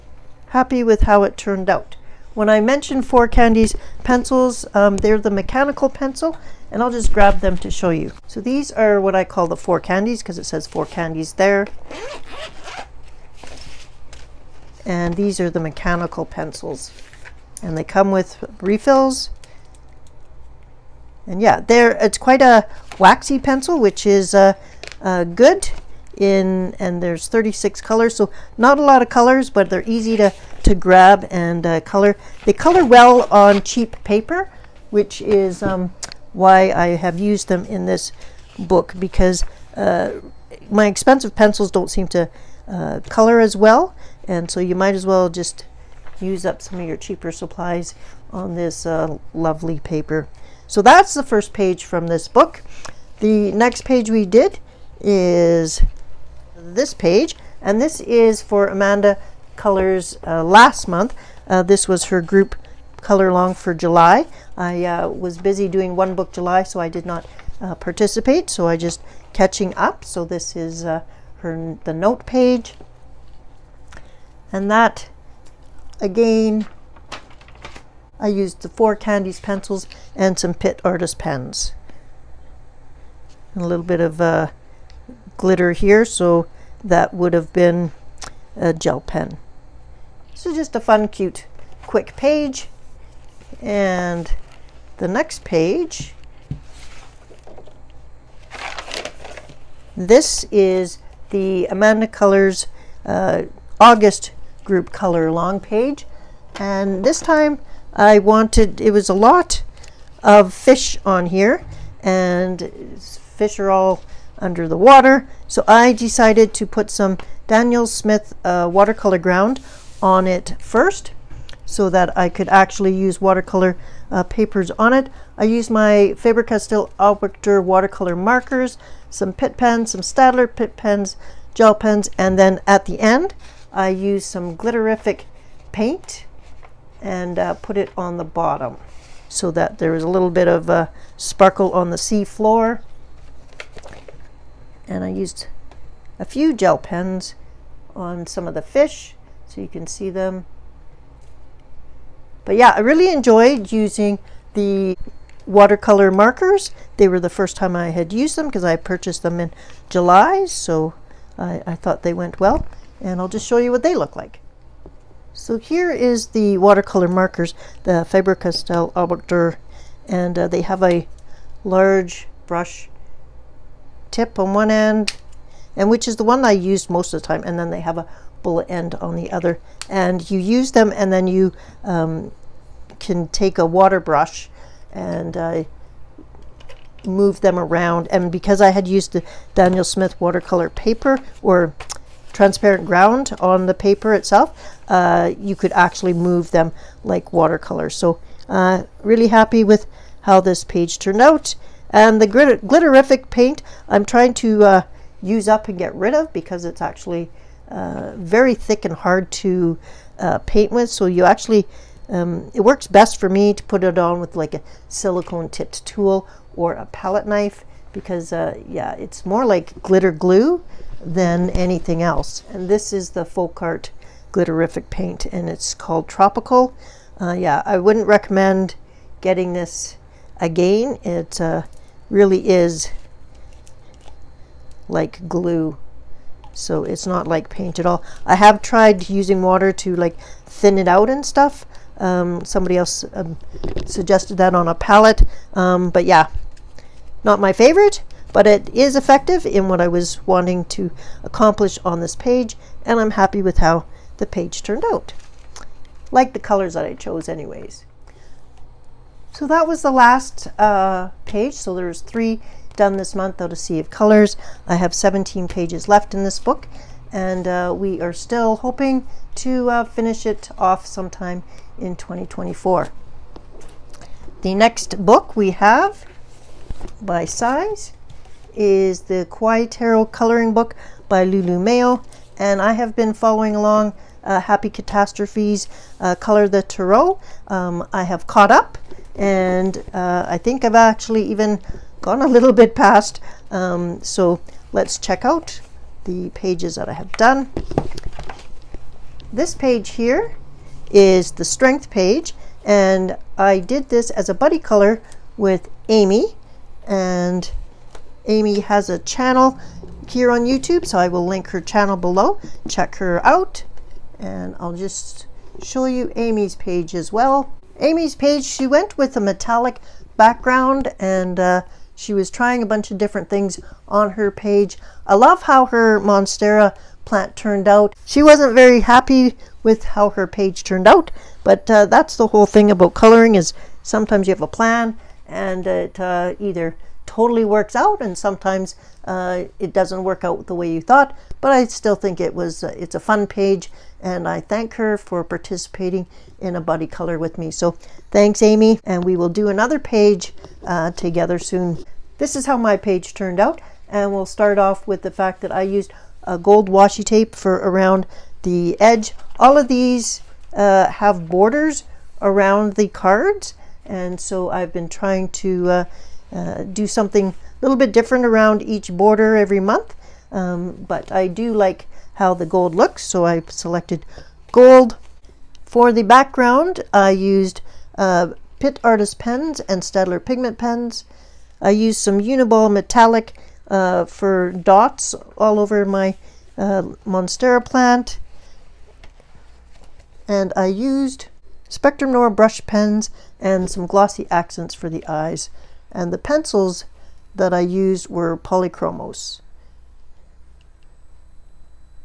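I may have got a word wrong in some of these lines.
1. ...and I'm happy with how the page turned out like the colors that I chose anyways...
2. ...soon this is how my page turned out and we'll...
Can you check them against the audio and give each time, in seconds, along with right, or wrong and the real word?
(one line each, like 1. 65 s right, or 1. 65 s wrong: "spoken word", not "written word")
1. 252 s right
2. 351 s right.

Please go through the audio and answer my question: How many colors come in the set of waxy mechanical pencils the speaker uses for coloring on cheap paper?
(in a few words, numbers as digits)
36.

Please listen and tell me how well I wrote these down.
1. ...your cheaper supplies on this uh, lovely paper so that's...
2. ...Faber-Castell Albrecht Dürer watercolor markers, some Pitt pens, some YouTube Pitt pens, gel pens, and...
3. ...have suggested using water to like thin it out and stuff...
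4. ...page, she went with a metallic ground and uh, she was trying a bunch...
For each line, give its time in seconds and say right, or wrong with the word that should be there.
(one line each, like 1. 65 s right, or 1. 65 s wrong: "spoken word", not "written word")
1. 46 s right
2. 126 s wrong: "Staedtler", not "YouTube"
3. 238 s wrong: "tried", not "suggested"
4. 318 s wrong: "background", not "ground".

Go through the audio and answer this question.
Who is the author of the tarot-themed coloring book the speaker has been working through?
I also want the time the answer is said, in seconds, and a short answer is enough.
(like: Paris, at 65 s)
Lulu Mayo, at 281 s.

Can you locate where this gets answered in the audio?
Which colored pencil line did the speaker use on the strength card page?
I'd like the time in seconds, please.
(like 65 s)
398 s.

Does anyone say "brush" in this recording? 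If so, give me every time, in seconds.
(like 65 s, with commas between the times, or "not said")
172 s, 183 s, 392 s.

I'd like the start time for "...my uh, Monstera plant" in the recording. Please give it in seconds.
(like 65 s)
385 s.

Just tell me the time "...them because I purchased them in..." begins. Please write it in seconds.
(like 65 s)
158 s.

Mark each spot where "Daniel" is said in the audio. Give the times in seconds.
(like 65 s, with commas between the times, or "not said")
117 s, 189 s.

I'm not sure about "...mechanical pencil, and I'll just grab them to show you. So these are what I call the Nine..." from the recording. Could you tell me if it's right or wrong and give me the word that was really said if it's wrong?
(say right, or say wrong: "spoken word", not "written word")
wrong: "Four", not "Nine".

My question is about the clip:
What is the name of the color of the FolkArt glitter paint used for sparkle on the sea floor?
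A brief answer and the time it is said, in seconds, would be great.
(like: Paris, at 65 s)
Tropical, at 226 s.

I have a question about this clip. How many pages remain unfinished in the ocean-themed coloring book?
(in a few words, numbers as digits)
17.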